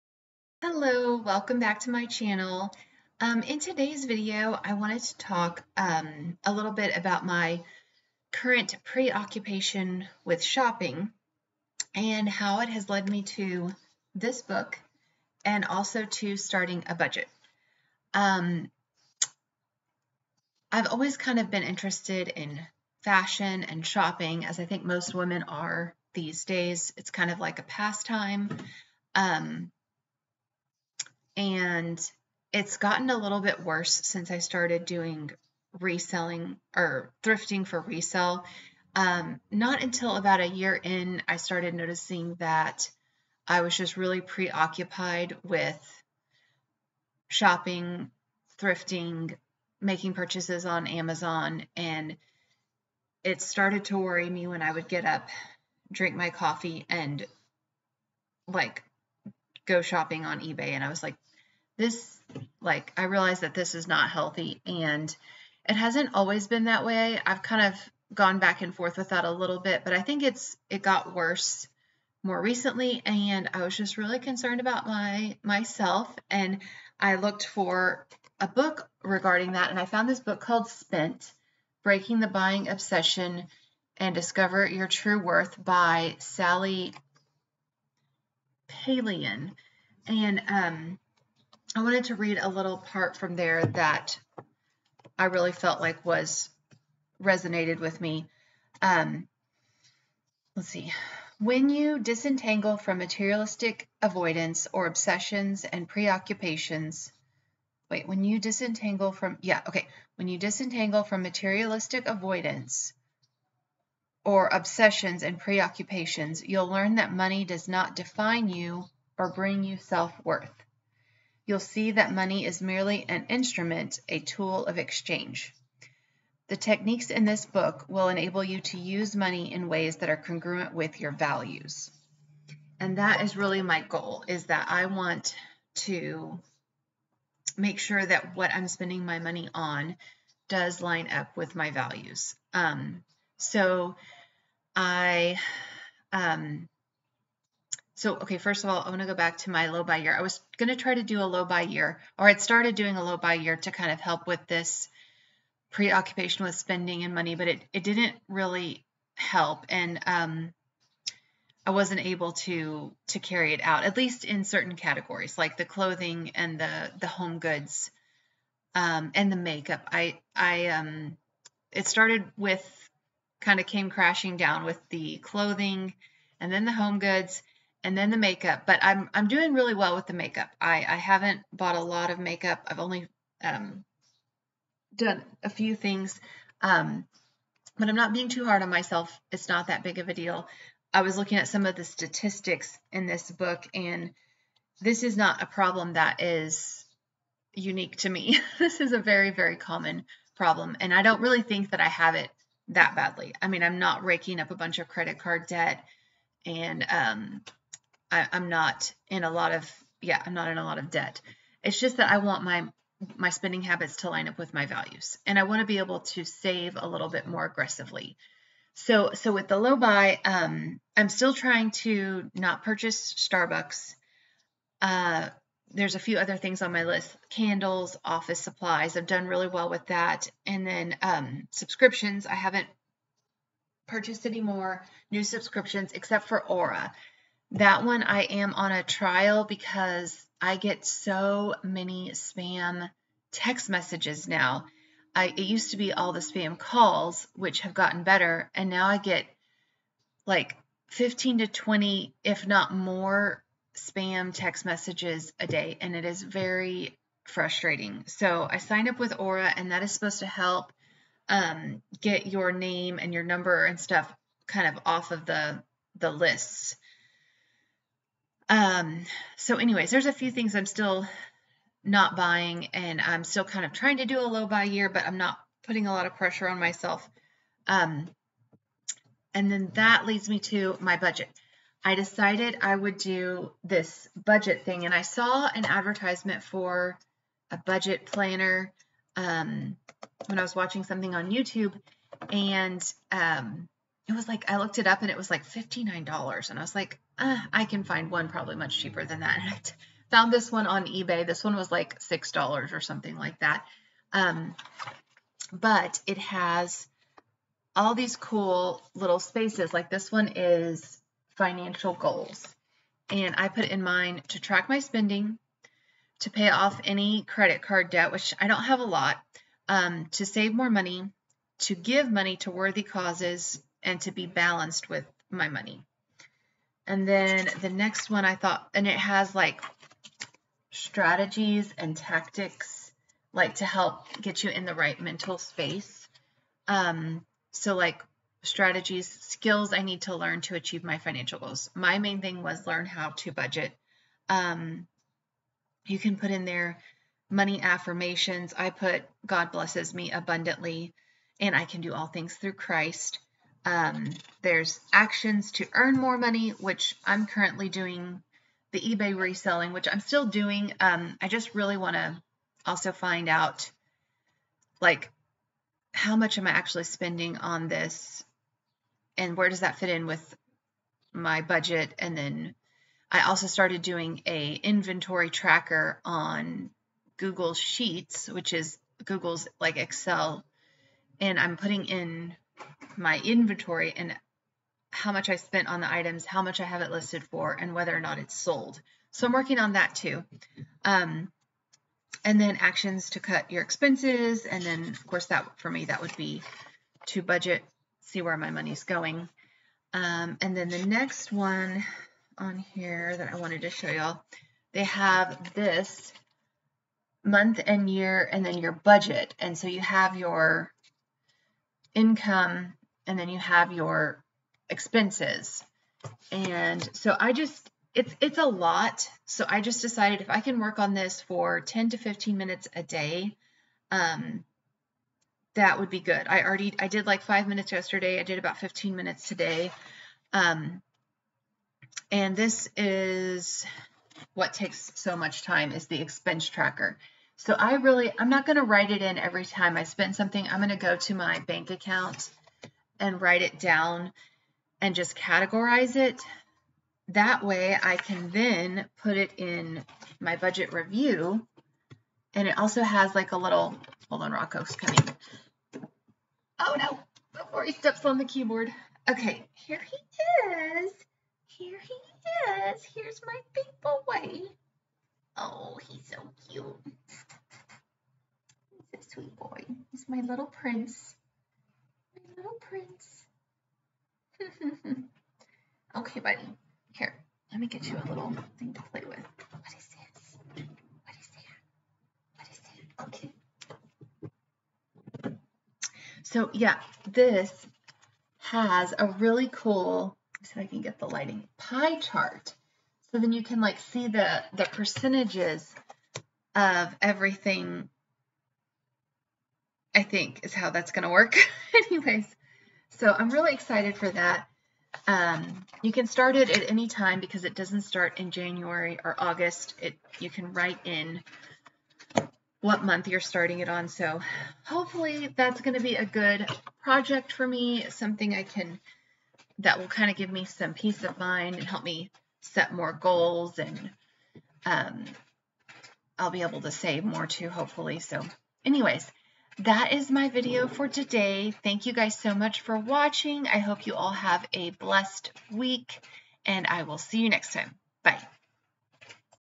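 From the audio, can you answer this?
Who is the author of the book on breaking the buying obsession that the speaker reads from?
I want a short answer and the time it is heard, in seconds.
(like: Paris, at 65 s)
Sally Palaian, at 86 s.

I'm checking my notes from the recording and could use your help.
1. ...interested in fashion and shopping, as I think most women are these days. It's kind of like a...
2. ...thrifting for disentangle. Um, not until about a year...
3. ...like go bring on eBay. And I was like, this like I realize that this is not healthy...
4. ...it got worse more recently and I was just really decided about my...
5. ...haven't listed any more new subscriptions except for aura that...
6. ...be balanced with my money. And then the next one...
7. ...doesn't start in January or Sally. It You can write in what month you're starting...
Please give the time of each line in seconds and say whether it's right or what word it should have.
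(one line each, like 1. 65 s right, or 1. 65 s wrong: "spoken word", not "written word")
1. 21 s right
2. 37 s wrong: "resale", not "disentangle"
3. 58 s wrong: "shopping", not "bring"
4. 70 s wrong: "concerned", not "decided"
5. 232 s wrong: "purchased", not "listed"
6. 324 s right
7. 507 s wrong: "August", not "Sally".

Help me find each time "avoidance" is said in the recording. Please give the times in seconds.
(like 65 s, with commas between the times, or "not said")
104 s, 112 s.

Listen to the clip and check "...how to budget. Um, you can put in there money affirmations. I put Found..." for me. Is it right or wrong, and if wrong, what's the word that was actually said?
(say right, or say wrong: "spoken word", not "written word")
wrong: "God", not "Found".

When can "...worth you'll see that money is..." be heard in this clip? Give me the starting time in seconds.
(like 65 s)
120 s.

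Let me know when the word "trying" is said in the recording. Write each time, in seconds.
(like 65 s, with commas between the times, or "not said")
221 s, 273 s.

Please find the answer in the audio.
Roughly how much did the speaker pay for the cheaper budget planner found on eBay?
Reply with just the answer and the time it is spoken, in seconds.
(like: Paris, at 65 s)
$6, at 301 s.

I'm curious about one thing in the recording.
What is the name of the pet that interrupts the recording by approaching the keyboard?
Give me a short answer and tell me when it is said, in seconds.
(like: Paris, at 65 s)
Rocco, at 454 s.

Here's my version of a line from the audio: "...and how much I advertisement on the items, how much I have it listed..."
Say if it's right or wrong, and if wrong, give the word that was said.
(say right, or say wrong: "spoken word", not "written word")
wrong: "spent", not "advertisement".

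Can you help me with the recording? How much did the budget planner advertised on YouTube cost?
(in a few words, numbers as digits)
$59.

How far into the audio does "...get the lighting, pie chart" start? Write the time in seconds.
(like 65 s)
490 s.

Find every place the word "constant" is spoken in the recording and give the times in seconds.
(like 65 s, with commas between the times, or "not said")
not said.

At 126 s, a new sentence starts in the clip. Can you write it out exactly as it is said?
The techniques in this book will enable you to use money in ways that are congruent with your values.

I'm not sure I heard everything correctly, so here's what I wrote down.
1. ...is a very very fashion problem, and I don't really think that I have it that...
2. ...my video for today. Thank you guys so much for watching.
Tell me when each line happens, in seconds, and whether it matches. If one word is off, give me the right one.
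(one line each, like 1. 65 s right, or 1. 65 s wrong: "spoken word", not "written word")
1. 198 s wrong: "common", not "fashion"
2. 530 s right.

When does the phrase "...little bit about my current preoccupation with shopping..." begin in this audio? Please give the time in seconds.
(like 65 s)
6 s.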